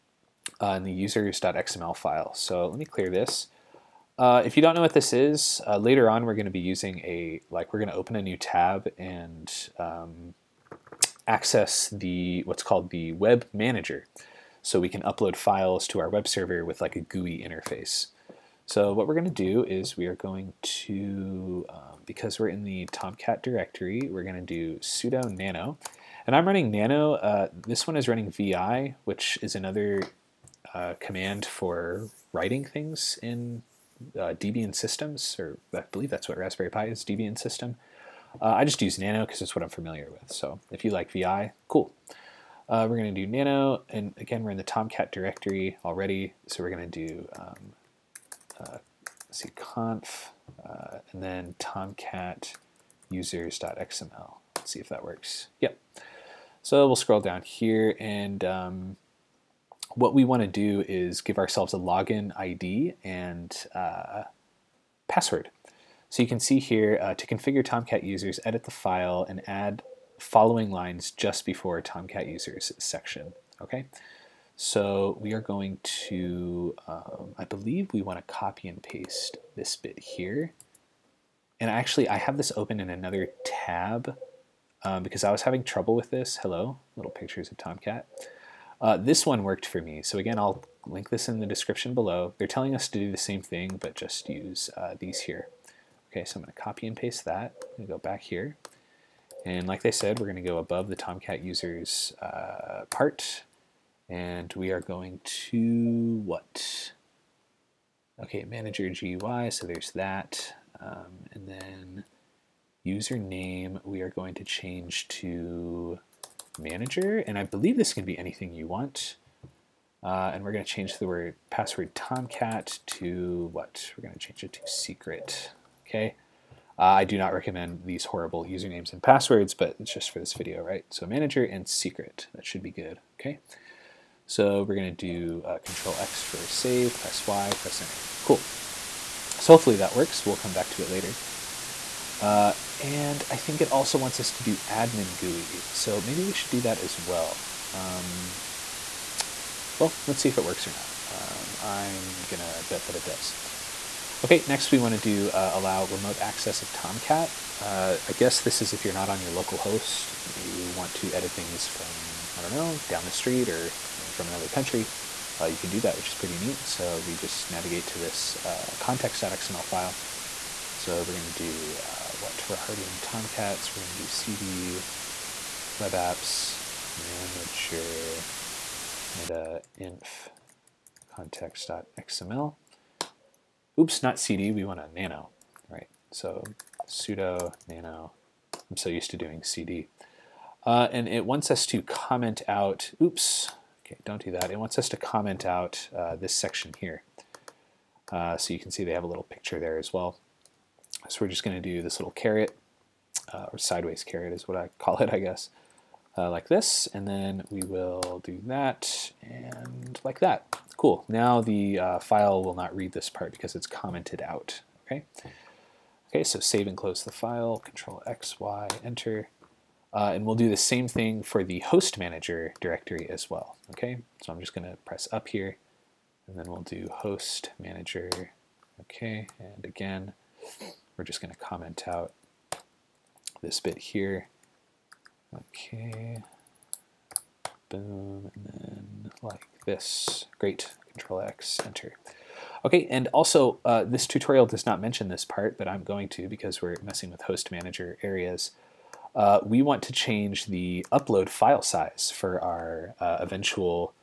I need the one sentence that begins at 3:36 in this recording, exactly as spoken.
Okay, so save and close the file, control X, Y, enter.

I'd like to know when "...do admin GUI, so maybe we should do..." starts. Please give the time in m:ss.
2:24.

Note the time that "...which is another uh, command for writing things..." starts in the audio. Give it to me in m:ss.
0:29.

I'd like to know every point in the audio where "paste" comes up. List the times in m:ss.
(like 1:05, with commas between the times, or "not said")
1:18, 1:36.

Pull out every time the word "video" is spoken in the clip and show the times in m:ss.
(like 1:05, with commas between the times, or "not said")
2:10.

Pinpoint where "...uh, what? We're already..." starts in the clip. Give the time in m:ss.
2:51.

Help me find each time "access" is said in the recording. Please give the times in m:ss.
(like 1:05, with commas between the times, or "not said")
0:11, 2:36.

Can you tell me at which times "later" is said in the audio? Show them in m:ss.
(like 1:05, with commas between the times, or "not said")
0:05, 2:20.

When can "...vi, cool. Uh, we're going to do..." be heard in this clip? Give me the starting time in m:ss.
0:41.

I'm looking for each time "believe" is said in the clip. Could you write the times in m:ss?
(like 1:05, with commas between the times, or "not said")
0:35, 1:17, 1:57.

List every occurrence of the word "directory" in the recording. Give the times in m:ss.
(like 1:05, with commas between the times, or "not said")
0:23, 0:45, 3:42.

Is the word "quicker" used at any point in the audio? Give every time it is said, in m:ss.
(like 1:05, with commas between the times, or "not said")
not said.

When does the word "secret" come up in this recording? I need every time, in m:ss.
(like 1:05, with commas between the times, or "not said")
2:04, 2:11.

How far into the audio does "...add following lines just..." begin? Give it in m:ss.
1:09.